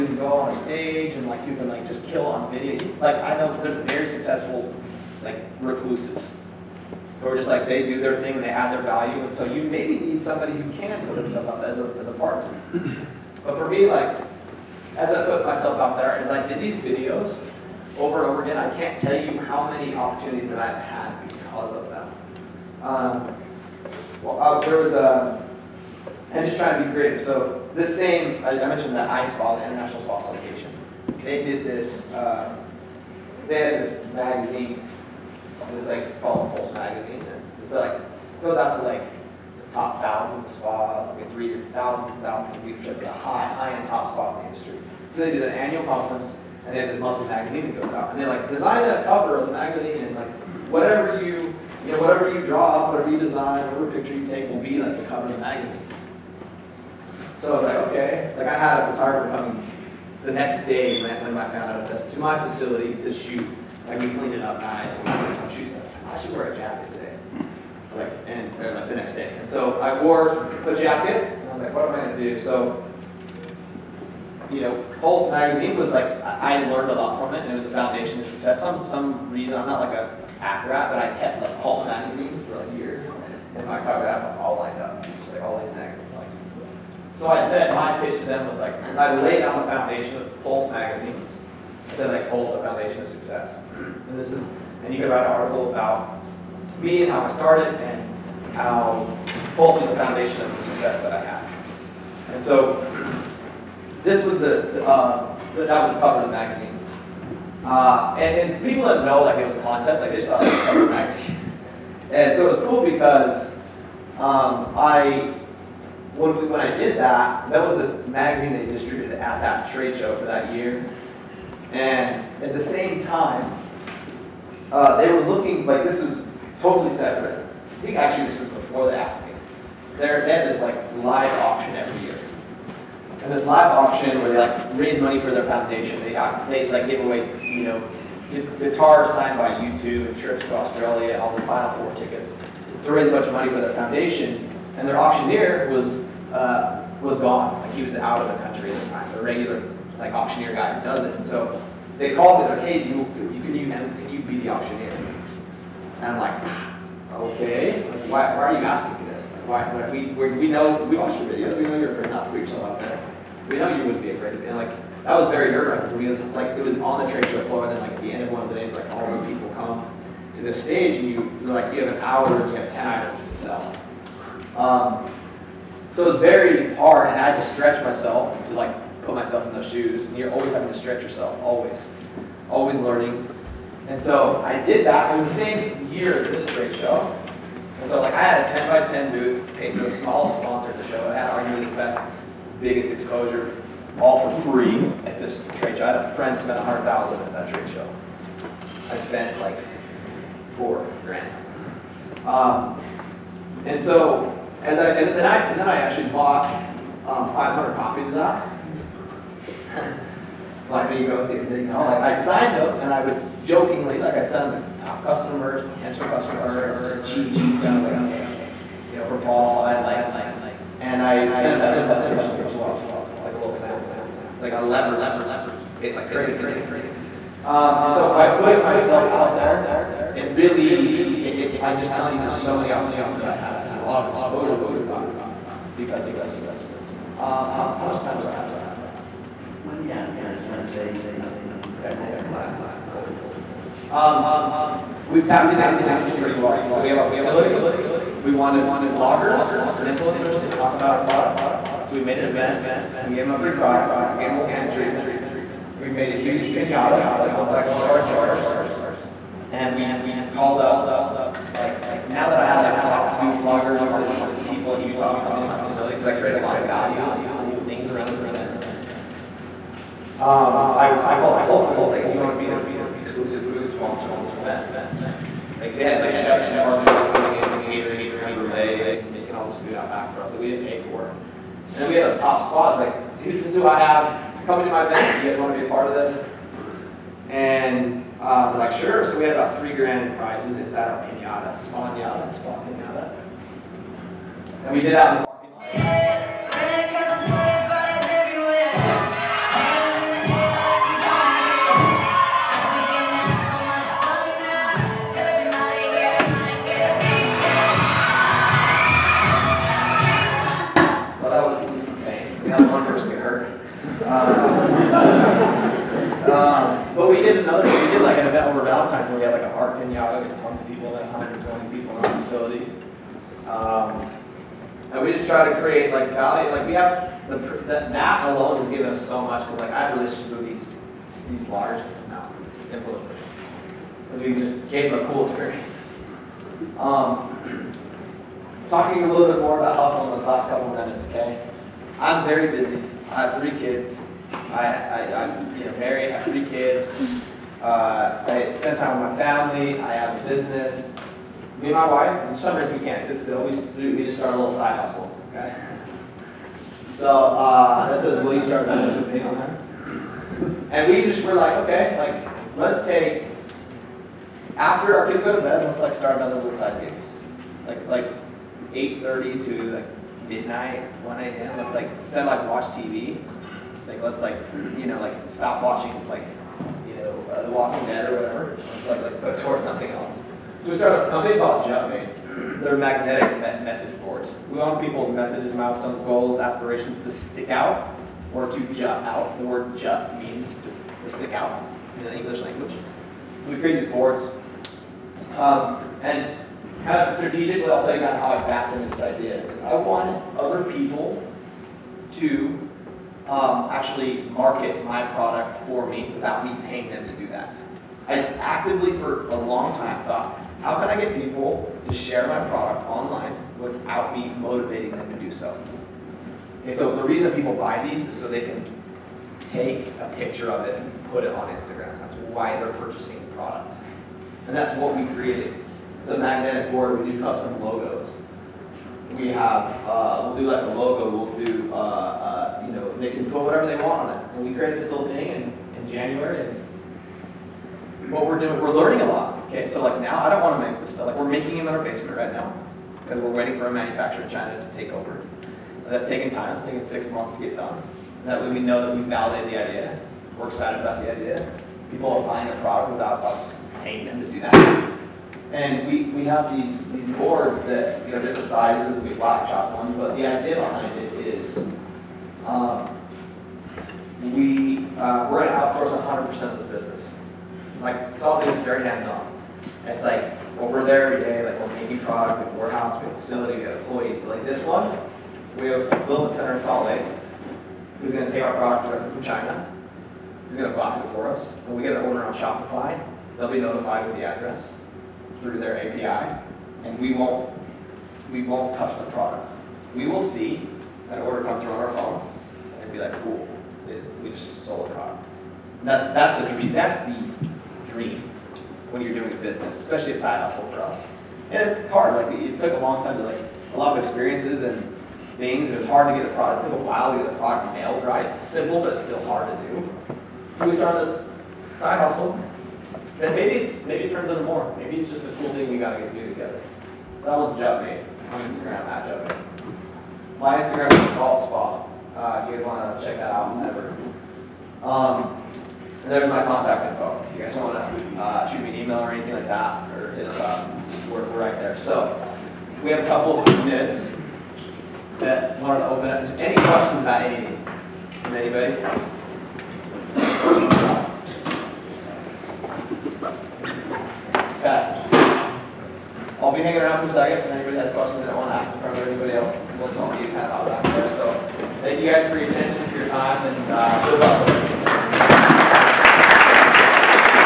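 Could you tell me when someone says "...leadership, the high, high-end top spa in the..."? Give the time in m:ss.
0:42.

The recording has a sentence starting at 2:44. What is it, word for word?
And like that was very nerve wracking for me.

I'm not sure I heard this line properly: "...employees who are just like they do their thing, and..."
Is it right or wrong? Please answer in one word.
wrong.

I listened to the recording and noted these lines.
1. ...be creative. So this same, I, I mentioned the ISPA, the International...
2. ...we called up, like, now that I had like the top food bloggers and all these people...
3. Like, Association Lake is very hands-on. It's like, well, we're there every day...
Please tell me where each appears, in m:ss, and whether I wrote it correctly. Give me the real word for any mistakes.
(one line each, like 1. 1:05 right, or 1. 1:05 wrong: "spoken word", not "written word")
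1. 0:26 right
2. 4:19 right
3. 7:47 wrong: "Salt", not "Association".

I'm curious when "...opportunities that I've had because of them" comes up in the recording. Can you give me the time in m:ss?
0:19.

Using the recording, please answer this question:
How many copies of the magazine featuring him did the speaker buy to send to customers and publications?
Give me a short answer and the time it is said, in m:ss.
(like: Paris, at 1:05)
500, at 3:27.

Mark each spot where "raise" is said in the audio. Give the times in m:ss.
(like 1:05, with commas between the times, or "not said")
2:14, 2:22.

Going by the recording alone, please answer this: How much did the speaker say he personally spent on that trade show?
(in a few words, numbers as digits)
4,000.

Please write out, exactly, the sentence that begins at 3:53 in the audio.
There's a lot of exposure that we've got because of this.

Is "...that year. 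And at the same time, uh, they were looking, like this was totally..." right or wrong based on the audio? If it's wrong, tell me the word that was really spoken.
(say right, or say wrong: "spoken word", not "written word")
right.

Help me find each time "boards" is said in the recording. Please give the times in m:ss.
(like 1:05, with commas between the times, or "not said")
6:24, 6:33, 7:06, 7:37.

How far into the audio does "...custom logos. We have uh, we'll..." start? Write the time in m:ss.
7:07.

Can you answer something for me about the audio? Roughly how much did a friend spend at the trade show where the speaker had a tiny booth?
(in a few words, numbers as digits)
100,000.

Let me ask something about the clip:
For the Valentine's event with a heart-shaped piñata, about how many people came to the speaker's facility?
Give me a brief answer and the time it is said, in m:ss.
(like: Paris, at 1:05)
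120, at 5:21.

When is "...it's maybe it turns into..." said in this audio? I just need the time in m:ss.
8:33.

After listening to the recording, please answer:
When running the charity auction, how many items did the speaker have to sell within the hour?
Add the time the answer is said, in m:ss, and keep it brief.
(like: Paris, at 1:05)
10, at 2:52.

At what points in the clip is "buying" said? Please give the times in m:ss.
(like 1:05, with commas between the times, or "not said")
7:32.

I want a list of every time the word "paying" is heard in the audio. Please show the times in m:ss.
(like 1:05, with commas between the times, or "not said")
6:46, 7:33.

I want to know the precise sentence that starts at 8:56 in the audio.
Any questions about anything from anybody?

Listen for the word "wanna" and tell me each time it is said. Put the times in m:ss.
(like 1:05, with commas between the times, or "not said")
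8:42, 8:47.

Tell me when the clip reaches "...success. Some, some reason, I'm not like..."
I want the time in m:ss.
1:18.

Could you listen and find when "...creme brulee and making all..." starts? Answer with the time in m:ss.
4:38.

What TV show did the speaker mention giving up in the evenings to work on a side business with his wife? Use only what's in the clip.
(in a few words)
The Walking Dead.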